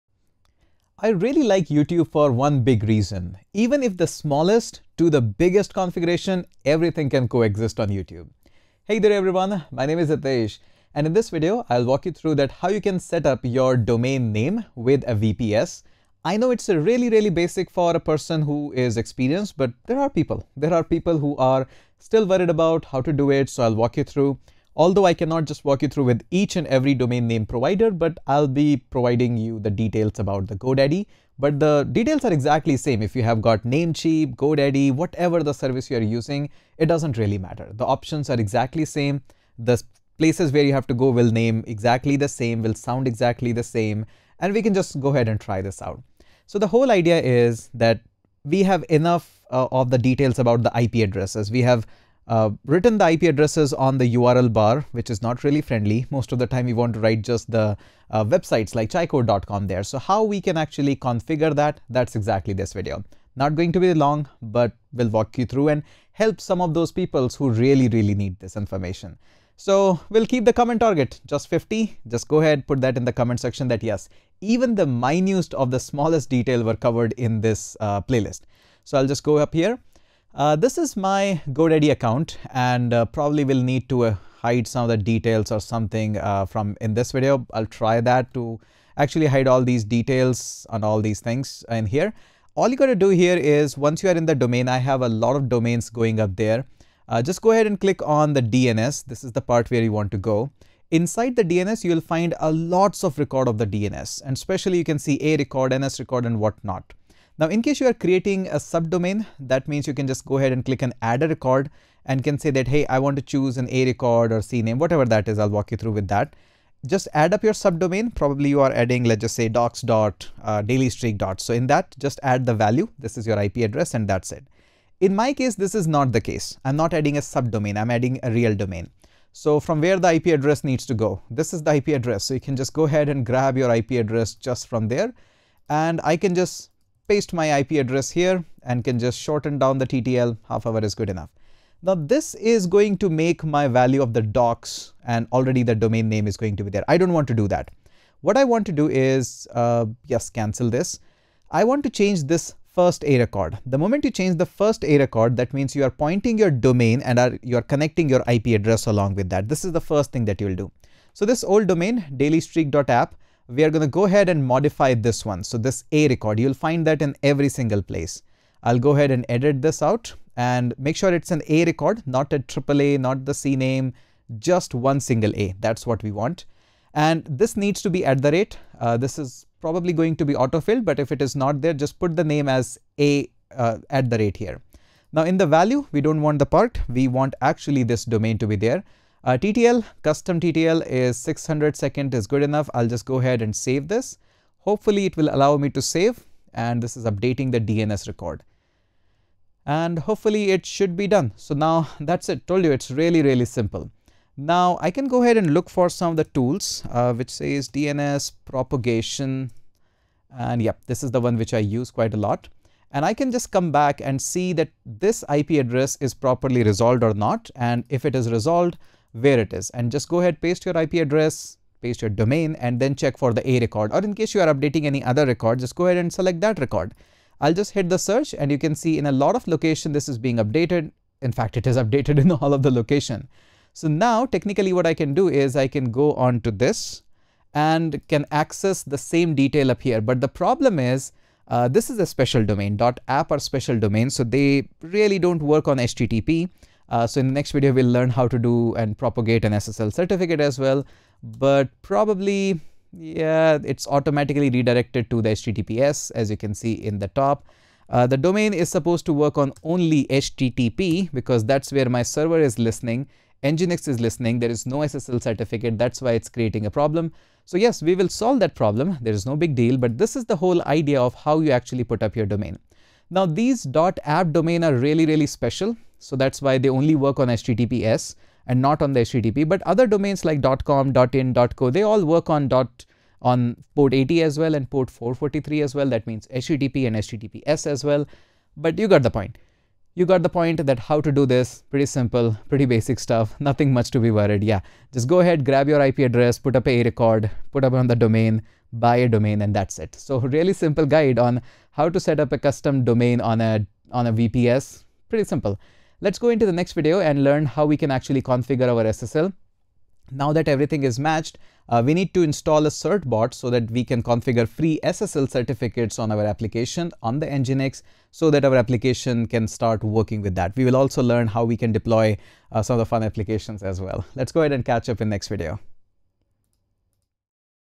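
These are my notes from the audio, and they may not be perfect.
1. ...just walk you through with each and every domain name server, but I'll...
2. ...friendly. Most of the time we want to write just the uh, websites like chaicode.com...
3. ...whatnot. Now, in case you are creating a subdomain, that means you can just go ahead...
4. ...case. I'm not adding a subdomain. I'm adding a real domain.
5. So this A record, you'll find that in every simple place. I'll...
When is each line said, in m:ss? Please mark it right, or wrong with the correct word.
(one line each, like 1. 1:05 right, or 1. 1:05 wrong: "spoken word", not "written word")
1. 0:25 wrong: "provider", not "server"
2. 0:55 right
3. 1:46 right
4. 2:06 right
5. 2:45 wrong: "single", not "simple".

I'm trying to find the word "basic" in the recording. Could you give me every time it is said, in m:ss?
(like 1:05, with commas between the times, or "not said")
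0:17, 4:52.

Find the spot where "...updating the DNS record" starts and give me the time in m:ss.
3:17.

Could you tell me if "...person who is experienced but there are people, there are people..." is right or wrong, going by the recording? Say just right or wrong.
right.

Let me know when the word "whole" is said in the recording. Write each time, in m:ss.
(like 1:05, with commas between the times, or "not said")
0:46, 4:30.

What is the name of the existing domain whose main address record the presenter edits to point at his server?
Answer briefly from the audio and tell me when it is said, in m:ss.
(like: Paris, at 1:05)
dailystreak.app, at 2:42.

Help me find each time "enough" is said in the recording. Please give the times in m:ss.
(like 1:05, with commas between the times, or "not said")
0:48, 2:21, 3:12.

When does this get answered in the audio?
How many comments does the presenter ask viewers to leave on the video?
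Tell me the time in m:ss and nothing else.
1:11.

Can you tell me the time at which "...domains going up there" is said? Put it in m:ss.
1:35.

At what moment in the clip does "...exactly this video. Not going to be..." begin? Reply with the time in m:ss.
1:02.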